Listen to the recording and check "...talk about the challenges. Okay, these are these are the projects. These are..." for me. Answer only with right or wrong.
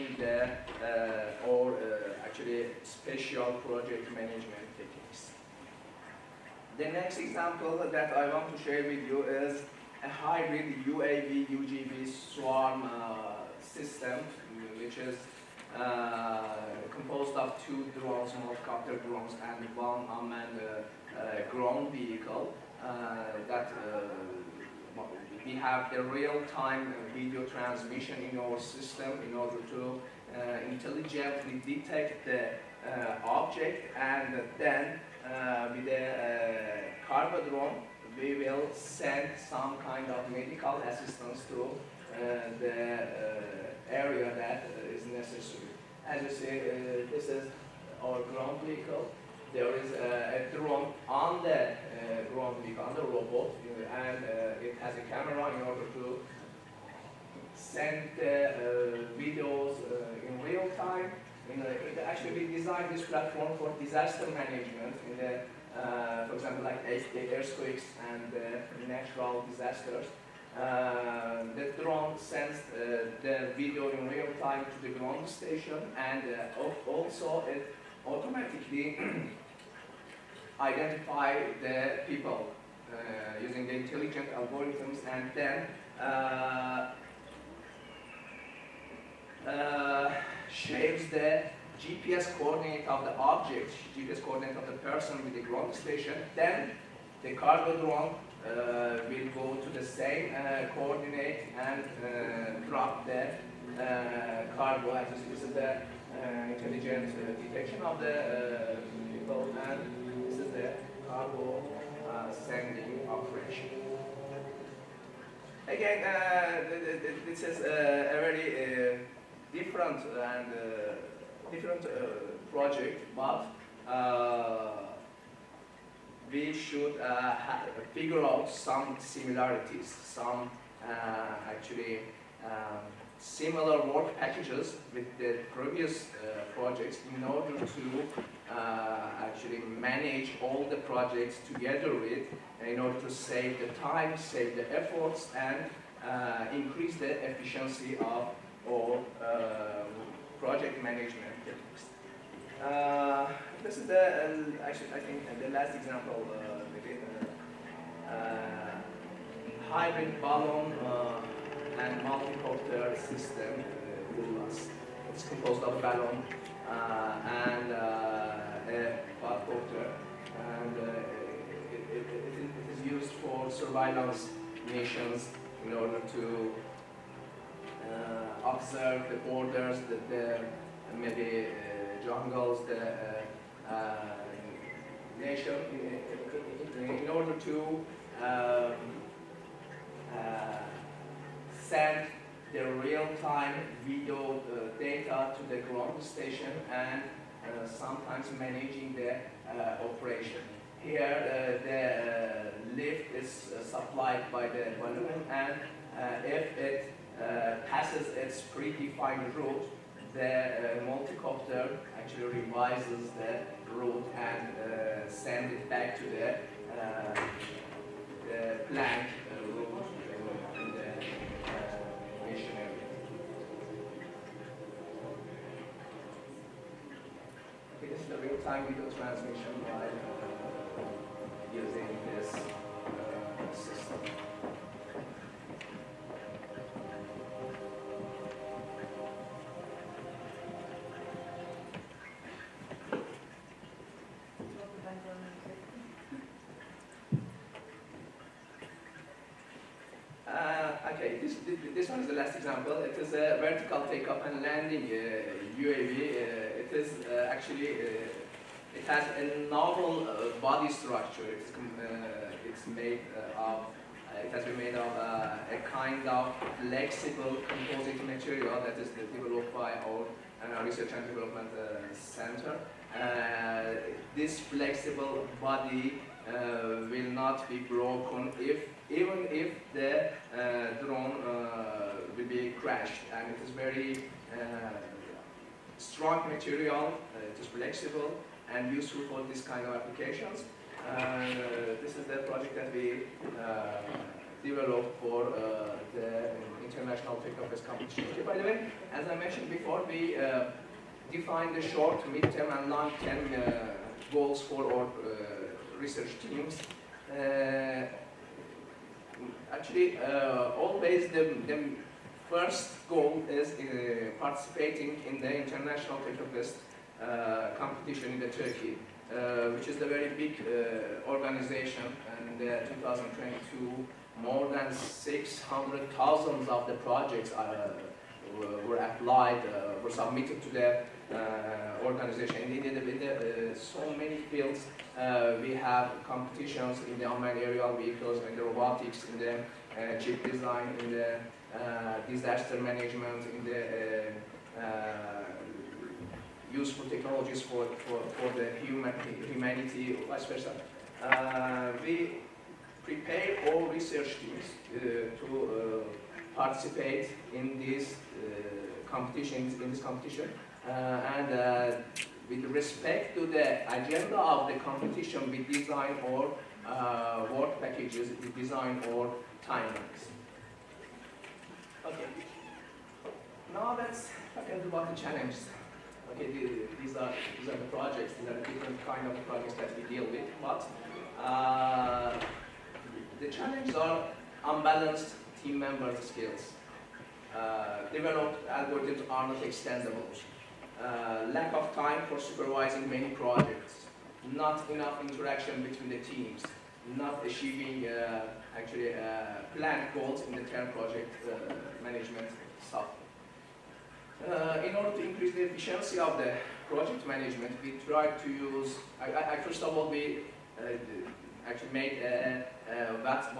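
right.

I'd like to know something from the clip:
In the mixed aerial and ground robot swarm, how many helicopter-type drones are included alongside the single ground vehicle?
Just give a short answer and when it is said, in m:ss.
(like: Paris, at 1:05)
2, at 0:17.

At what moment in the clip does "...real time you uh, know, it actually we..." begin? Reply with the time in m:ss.
1:00.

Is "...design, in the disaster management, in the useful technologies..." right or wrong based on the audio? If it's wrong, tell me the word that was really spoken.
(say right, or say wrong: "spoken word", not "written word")
right.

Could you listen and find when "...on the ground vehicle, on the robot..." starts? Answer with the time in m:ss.
0:51.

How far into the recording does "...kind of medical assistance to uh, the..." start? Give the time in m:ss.
0:39.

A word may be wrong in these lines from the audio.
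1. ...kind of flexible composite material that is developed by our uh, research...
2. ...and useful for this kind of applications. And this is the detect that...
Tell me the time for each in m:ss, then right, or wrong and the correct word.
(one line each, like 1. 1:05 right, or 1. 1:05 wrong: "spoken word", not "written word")
1. 4:25 right
2. 4:48 wrong: "project", not "detect".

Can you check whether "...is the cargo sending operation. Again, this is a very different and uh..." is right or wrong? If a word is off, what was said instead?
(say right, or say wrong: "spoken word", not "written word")
right.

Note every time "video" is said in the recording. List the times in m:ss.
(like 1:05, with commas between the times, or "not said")
0:27, 0:59, 1:13, 3:13, 3:48.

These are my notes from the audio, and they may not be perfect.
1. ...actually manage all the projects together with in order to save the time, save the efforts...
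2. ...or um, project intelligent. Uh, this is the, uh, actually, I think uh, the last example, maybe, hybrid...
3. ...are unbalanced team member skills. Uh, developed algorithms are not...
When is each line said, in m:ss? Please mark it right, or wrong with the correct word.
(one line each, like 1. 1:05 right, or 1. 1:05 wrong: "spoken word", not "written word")
1. 2:19 right
2. 2:28 wrong: "management", not "intelligent"
3. 6:23 right.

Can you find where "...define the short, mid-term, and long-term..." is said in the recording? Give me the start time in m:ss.
5:01.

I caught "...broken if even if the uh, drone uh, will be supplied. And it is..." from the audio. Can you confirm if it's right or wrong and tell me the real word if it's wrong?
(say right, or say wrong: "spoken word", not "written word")
wrong: "crashed", not "supplied".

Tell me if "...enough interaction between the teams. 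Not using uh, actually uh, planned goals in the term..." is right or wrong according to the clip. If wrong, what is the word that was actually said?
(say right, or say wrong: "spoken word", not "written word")
wrong: "achieving", not "using".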